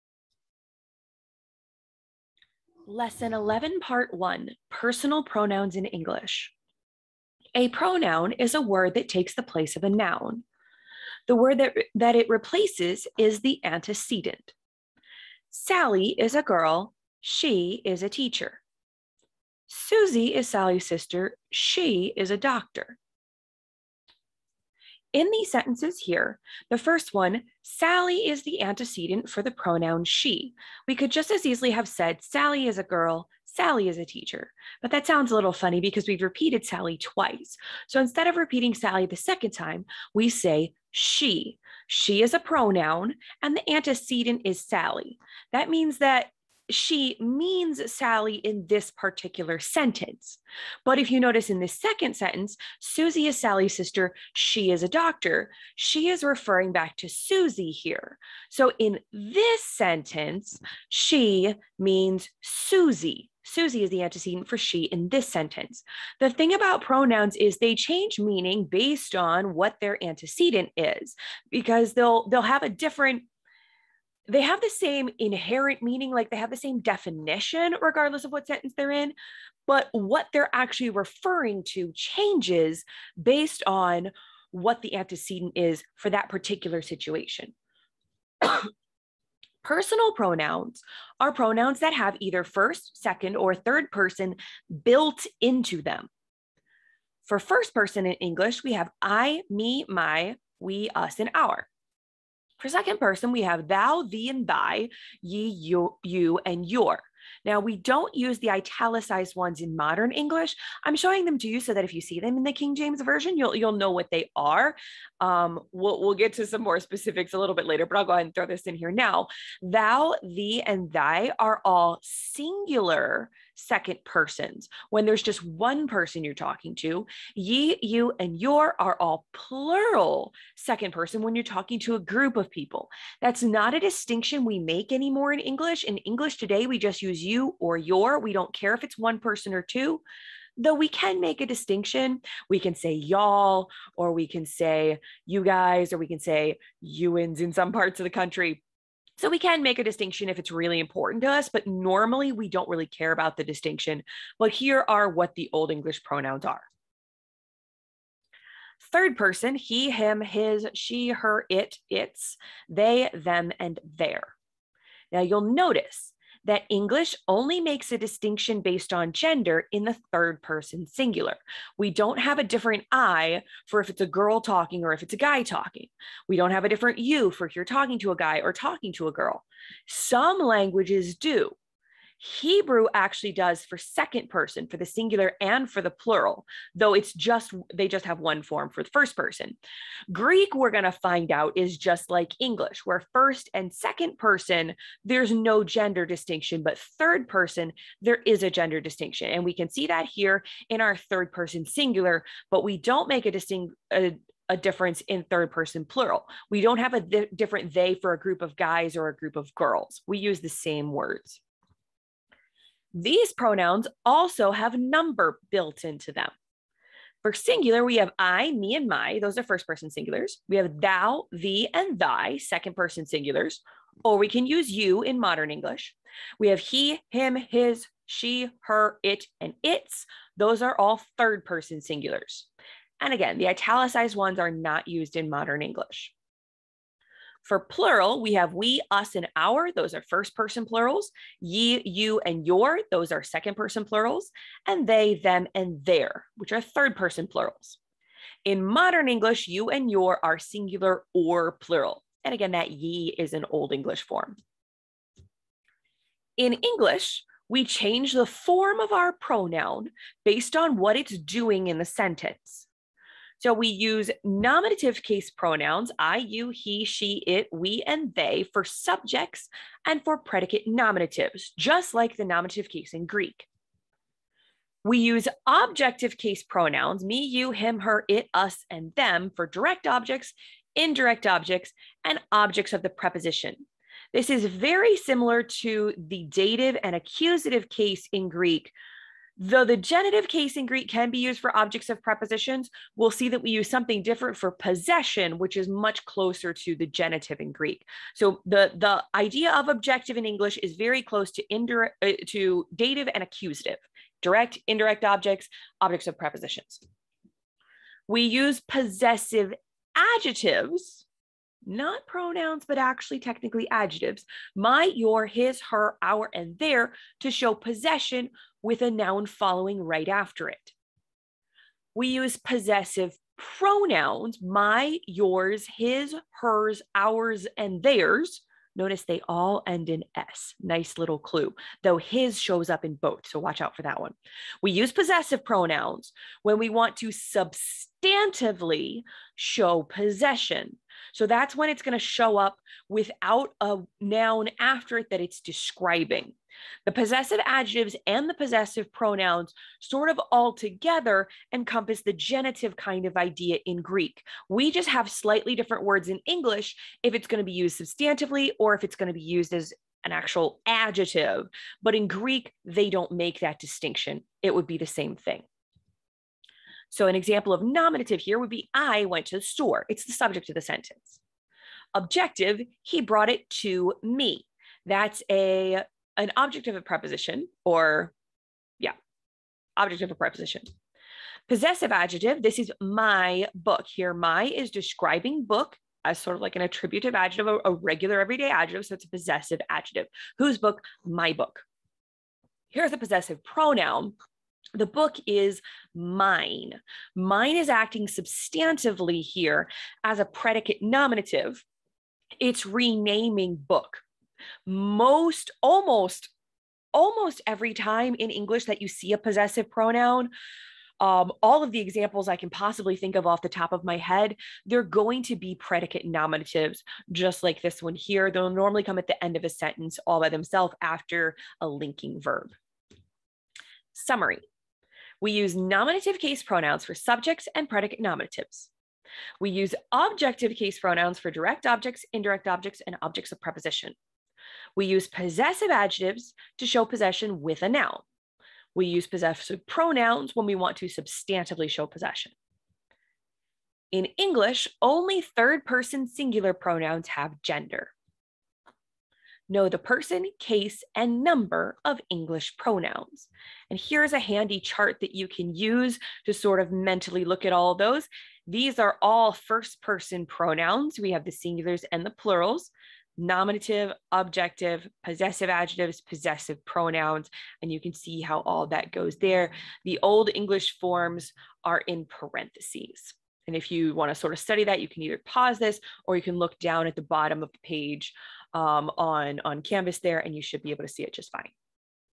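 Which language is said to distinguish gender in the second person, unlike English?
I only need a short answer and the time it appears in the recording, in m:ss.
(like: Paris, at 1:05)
Hebrew, at 3:02.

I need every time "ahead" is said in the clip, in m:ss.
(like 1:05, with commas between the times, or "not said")
1:58.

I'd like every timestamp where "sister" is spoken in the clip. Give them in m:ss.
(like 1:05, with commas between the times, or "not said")
0:20, 0:53.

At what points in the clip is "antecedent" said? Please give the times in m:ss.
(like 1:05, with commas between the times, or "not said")
0:13, 0:28, 0:43, 1:04, 1:10, 1:24.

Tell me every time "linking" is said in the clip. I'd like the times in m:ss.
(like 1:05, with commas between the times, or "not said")
7:01.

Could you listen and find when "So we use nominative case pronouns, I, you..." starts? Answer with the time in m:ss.
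4:23.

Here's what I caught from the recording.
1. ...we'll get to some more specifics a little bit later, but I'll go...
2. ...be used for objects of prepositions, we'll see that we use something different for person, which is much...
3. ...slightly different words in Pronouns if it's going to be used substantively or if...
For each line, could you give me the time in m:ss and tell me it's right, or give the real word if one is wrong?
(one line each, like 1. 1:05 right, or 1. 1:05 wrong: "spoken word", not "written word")
1. 1:56 right
2. 4:51 wrong: "possession", not "person"
3. 5:55 wrong: "English", not "Pronouns".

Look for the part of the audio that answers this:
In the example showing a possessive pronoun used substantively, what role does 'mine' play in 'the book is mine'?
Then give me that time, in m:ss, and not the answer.
6:40.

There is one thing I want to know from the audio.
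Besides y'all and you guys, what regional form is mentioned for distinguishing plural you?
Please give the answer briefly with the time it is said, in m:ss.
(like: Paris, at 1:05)
youins, at 2:26.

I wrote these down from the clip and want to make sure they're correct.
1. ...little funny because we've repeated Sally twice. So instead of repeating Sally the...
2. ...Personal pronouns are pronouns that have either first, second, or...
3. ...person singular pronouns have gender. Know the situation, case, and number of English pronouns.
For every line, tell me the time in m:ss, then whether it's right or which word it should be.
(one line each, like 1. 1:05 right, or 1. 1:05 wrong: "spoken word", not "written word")
1. 0:35 right
2. 1:29 right
3. 7:25 wrong: "person", not "situation".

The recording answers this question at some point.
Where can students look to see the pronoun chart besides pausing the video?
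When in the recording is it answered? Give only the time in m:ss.
7:59.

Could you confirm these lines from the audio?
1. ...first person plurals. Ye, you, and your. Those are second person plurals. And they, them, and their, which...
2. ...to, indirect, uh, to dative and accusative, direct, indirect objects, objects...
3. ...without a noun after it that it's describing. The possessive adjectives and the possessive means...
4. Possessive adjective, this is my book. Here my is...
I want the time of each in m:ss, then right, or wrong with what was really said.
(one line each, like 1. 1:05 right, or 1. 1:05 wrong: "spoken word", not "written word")
1. 4:00 right
2. 5:01 right
3. 5:42 wrong: "pronouns", not "means"
4. 6:21 right.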